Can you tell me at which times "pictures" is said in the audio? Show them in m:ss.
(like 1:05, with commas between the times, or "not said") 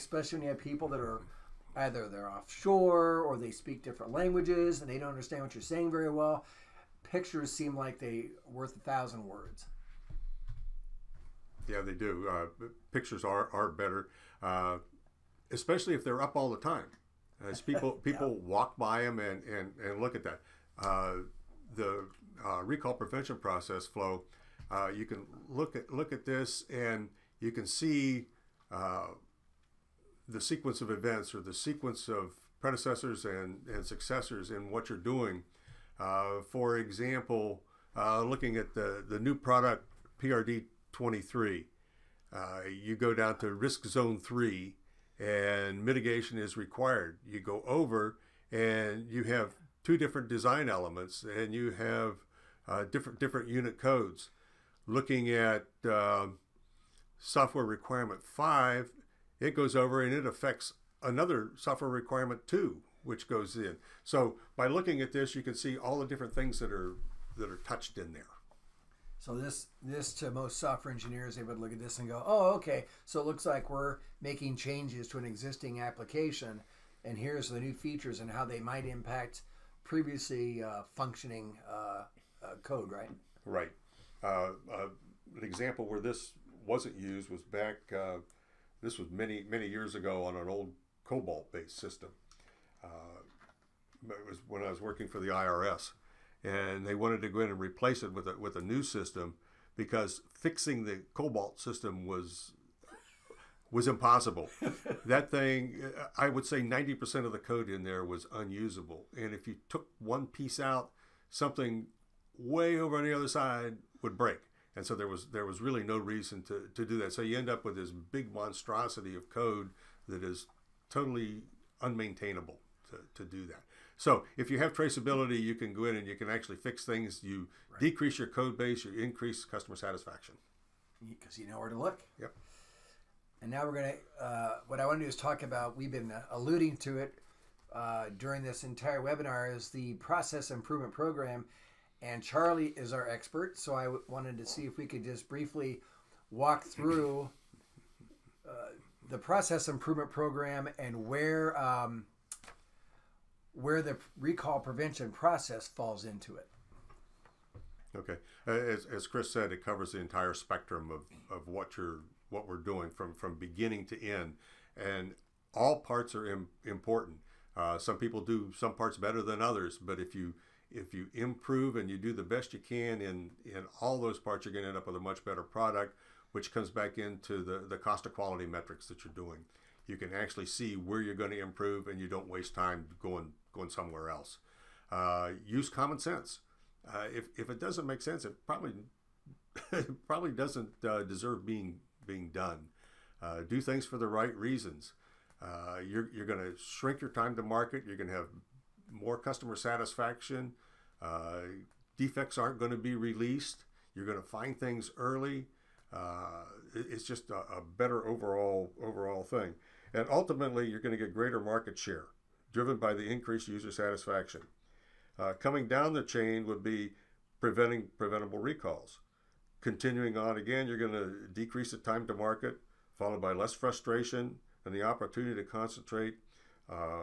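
0:07, 0:12.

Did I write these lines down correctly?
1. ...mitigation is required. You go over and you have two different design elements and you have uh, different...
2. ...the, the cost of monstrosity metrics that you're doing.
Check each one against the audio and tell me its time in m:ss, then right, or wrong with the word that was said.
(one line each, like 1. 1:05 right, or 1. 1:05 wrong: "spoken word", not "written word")
1. 0:45 right
2. 2:57 wrong: "quality", not "monstrosity".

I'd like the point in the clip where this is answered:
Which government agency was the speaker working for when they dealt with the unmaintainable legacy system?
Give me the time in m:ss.
1:35.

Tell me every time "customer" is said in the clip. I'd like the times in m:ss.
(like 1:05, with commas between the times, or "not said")
2:09, 3:19.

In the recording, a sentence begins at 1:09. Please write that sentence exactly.
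So this this to most software engineers, they would look at this and go, "Oh, okay.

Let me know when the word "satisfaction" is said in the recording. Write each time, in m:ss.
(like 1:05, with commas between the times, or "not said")
2:09, 3:19, 3:33.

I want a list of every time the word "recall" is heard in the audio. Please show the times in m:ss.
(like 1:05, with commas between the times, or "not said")
0:22, 2:34, 3:38.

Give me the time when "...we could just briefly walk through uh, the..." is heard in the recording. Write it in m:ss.
2:24.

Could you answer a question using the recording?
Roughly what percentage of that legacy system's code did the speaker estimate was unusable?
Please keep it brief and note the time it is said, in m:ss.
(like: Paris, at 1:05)
90%, at 1:46.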